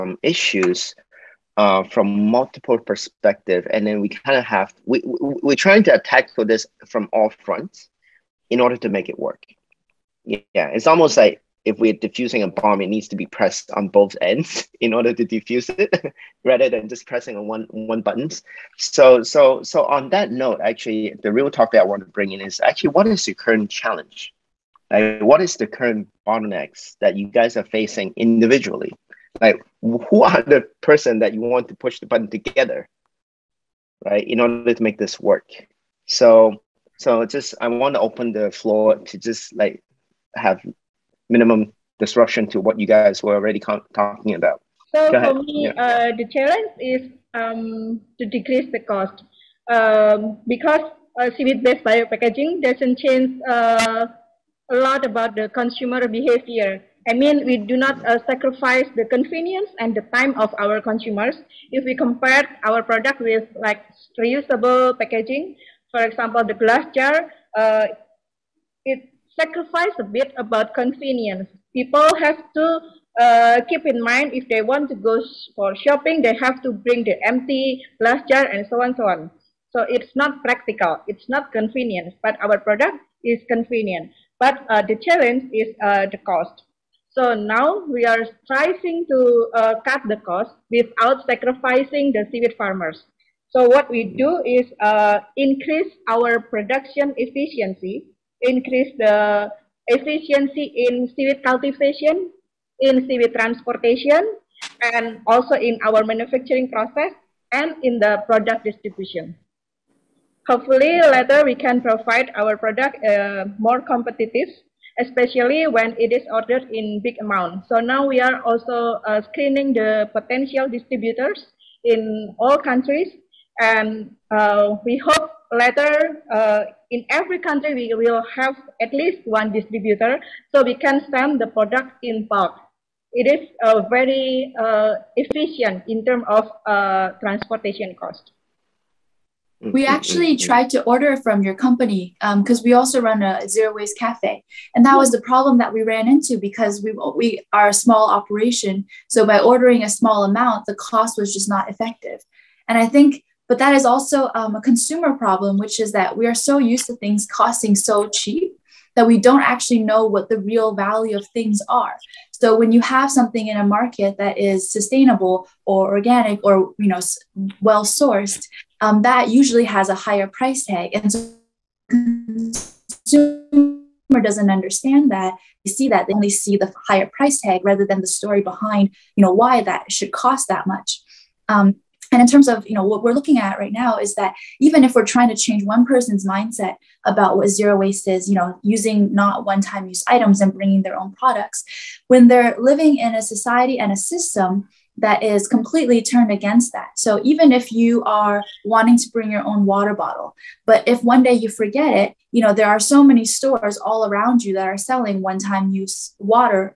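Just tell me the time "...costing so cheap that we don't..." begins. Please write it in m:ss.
2:37.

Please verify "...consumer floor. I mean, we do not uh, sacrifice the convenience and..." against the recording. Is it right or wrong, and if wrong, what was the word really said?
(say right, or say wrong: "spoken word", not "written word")
wrong: "behavior", not "floor".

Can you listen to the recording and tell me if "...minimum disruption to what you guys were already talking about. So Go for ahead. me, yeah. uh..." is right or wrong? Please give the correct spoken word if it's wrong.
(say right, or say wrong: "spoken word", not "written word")
right.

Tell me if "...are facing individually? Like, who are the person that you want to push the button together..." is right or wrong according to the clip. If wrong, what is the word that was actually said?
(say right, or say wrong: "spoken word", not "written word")
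right.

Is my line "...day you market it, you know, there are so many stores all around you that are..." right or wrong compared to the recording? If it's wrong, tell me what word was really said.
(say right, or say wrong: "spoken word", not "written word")
wrong: "forget", not "market".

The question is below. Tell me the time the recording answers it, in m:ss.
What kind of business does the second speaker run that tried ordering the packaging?
2:23.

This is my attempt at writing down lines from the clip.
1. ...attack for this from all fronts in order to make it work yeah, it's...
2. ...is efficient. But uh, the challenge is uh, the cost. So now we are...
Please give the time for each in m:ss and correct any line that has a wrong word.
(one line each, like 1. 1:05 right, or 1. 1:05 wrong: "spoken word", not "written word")
1. 0:05 right
2. 1:23 wrong: "convenient", not "efficient".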